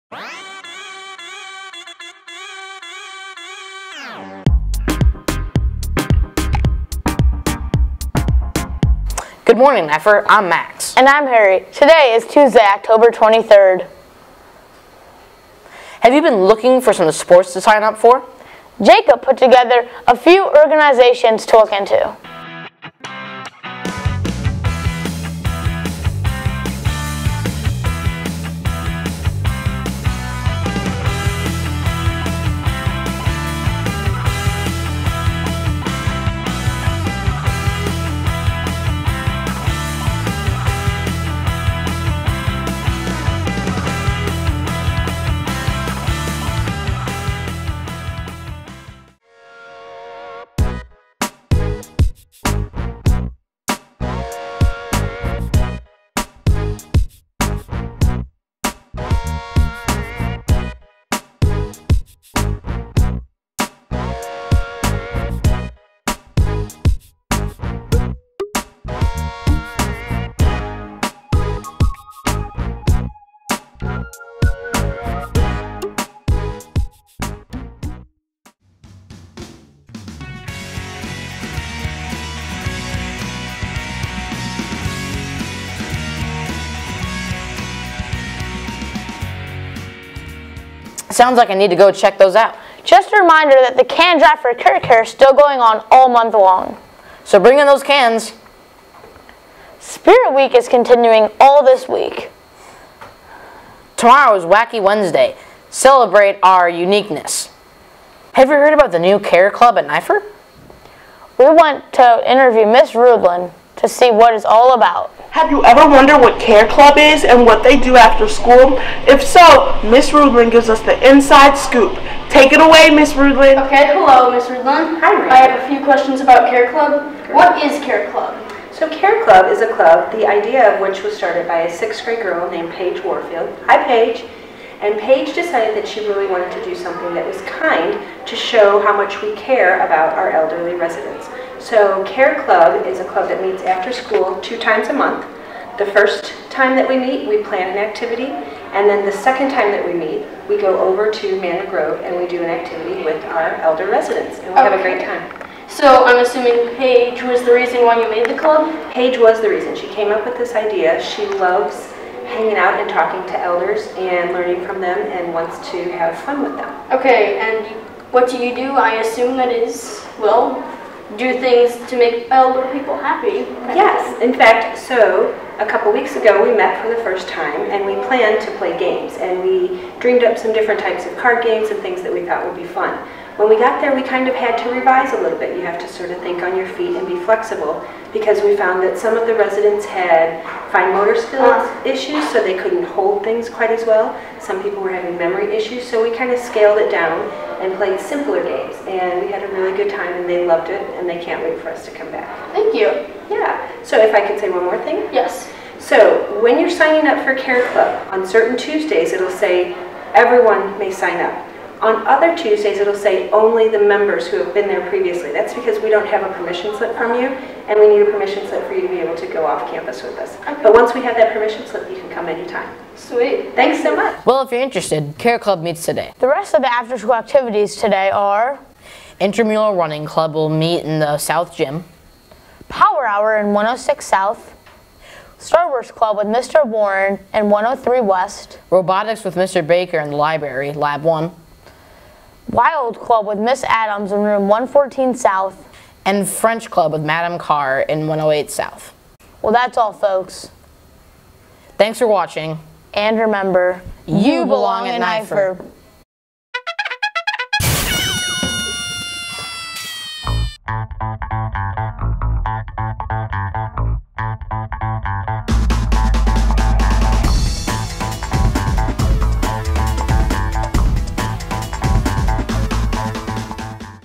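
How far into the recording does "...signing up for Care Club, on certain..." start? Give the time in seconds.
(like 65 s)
206 s.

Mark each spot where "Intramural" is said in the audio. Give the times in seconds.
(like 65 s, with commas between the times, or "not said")
229 s.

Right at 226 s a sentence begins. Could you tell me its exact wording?
The rest of the after-school activities today are...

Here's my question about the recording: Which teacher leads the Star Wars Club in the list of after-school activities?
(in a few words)
Mr. Warren.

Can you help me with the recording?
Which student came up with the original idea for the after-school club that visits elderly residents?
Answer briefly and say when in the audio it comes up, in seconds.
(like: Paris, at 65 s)
Paige Warfield, at 132 s.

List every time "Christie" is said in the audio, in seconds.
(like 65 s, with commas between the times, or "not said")
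not said.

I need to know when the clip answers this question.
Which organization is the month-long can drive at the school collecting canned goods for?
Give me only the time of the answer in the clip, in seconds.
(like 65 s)
94 s.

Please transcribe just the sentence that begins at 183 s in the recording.
When we got there, we kind of had to revise a little bit.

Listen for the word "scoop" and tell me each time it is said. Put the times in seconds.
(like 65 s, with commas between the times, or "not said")
121 s.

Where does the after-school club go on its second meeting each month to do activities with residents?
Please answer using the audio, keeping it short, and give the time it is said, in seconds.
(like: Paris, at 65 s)
Manor Grove, at 151 s.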